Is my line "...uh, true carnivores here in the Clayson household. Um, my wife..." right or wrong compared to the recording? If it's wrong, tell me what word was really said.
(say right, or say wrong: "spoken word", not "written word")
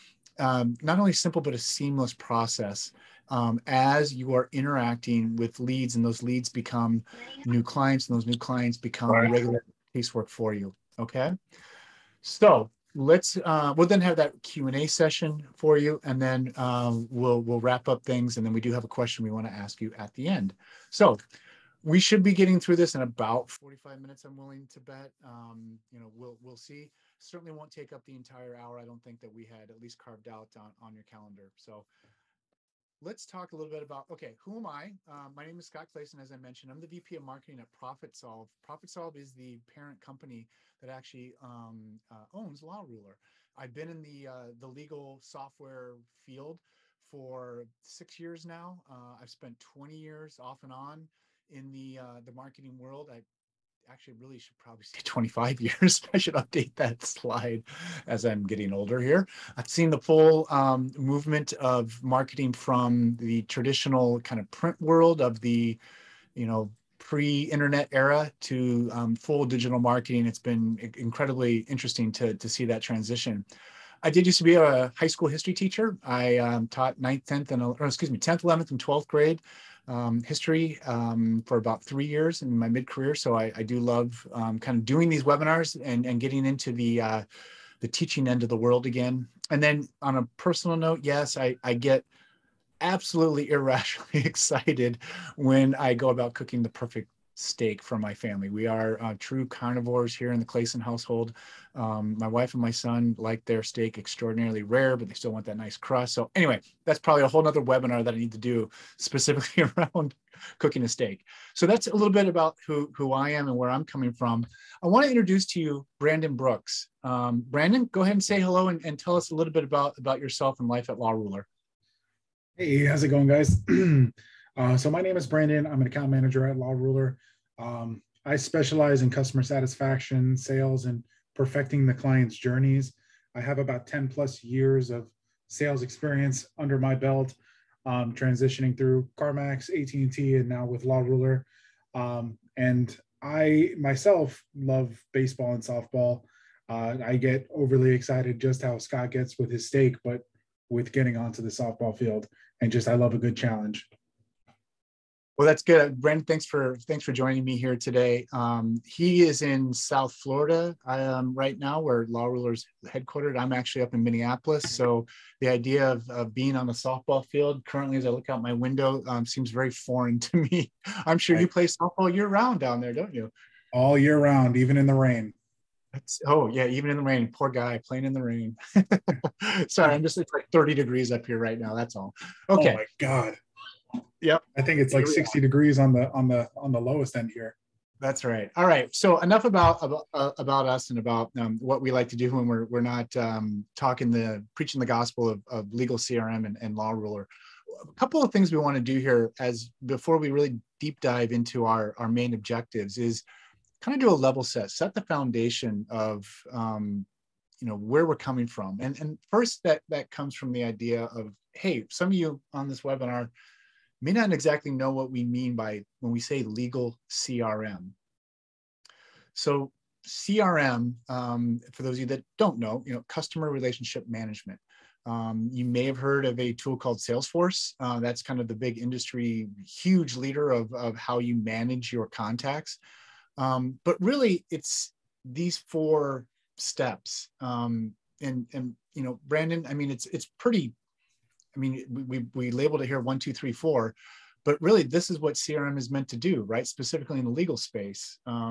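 right.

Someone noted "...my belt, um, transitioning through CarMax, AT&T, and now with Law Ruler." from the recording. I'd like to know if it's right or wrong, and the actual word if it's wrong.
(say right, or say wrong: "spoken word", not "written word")
right.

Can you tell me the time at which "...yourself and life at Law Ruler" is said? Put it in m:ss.
2:00.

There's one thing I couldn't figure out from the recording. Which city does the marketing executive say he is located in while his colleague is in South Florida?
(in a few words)
Minneapolis.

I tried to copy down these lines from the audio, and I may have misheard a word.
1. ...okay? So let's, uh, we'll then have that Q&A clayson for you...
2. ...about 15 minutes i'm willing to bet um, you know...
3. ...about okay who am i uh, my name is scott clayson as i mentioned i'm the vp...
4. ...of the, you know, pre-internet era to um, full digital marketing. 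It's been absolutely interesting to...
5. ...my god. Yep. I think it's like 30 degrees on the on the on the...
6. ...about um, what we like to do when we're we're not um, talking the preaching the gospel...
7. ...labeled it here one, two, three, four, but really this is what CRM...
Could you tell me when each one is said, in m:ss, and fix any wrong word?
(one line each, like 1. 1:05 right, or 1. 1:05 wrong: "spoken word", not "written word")
1. 0:10 wrong: "session", not "clayson"
2. 0:23 wrong: "45", not "15"
3. 0:33 right
4. 1:05 wrong: "incredibly", not "absolutely"
5. 3:02 wrong: "60", not "30"
6. 3:10 right
7. 4:02 right.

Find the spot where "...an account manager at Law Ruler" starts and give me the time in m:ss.
2:05.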